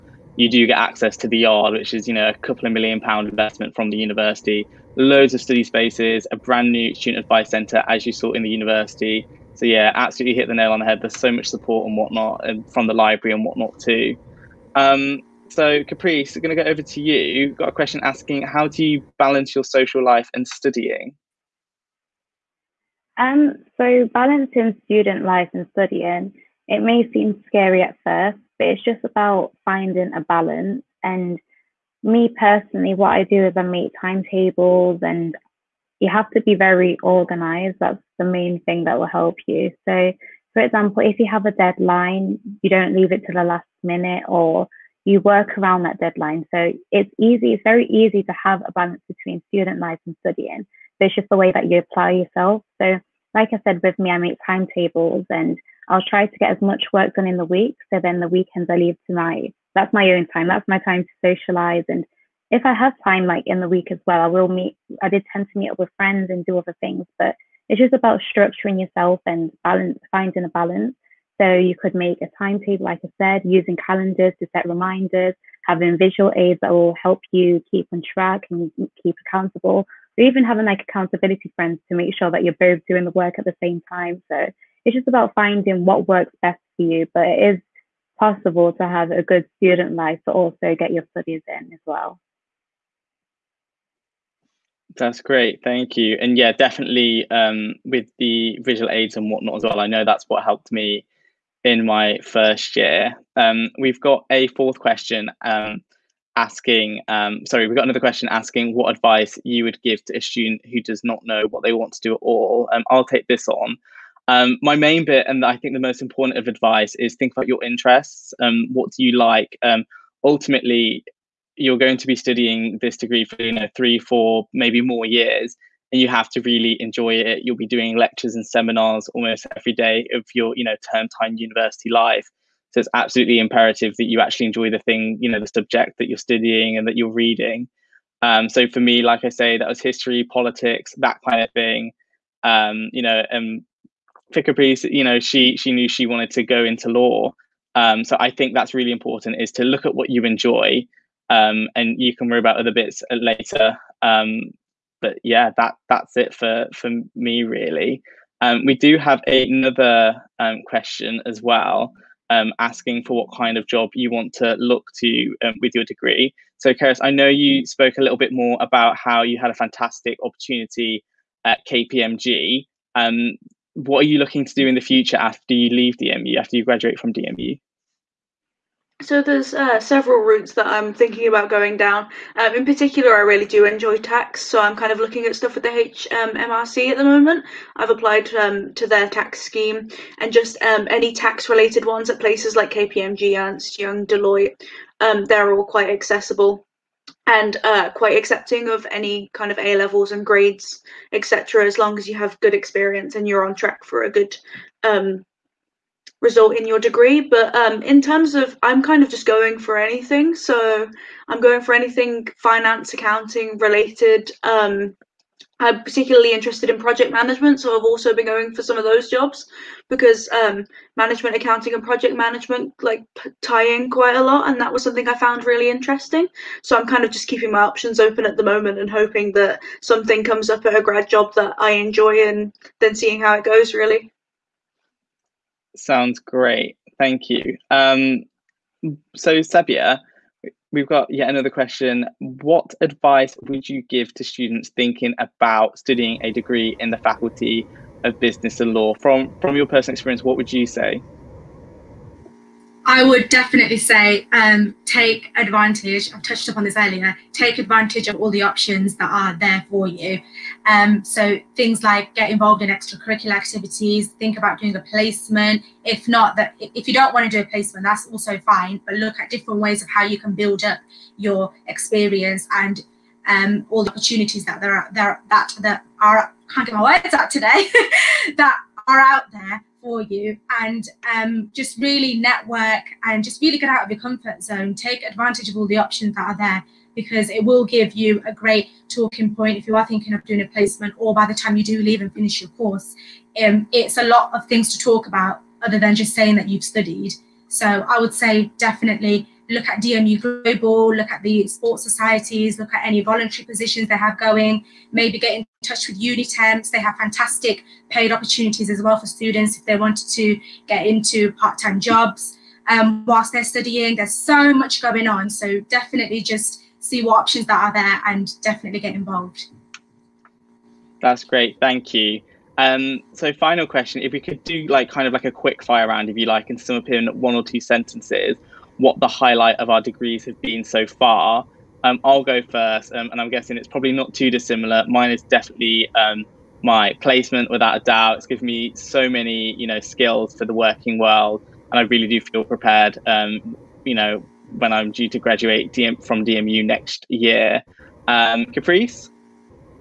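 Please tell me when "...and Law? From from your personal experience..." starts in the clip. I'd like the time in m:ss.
4:08.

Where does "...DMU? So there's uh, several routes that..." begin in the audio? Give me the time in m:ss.
2:57.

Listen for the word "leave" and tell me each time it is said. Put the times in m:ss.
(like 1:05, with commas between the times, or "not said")
0:42, 0:58, 2:55, 4:51.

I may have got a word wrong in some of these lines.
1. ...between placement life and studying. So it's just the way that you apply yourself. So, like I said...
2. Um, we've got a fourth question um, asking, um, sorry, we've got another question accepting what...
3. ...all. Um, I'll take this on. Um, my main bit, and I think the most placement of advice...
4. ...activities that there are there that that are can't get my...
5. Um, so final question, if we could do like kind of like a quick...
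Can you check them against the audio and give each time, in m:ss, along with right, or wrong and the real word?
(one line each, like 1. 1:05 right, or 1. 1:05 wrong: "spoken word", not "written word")
1. 0:49 wrong: "student", not "placement"
2. 1:43 wrong: "asking", not "accepting"
3. 1:52 wrong: "important", not "placement"
4. 4:33 wrong: "opportunities", not "activities"
5. 5:22 right.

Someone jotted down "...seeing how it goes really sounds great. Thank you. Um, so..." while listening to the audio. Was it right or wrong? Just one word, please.
right.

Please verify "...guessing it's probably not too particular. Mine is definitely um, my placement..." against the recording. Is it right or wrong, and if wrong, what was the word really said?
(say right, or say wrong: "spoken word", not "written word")
wrong: "dissimilar", not "particular".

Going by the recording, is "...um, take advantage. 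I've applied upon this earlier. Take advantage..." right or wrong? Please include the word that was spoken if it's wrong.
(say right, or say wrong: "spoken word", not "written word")
wrong: "touched", not "applied".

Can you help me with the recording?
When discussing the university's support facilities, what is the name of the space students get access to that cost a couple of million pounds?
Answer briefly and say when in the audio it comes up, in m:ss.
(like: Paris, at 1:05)
The Yard, at 0:01.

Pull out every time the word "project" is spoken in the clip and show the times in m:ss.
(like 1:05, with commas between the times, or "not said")
3:36, 3:41.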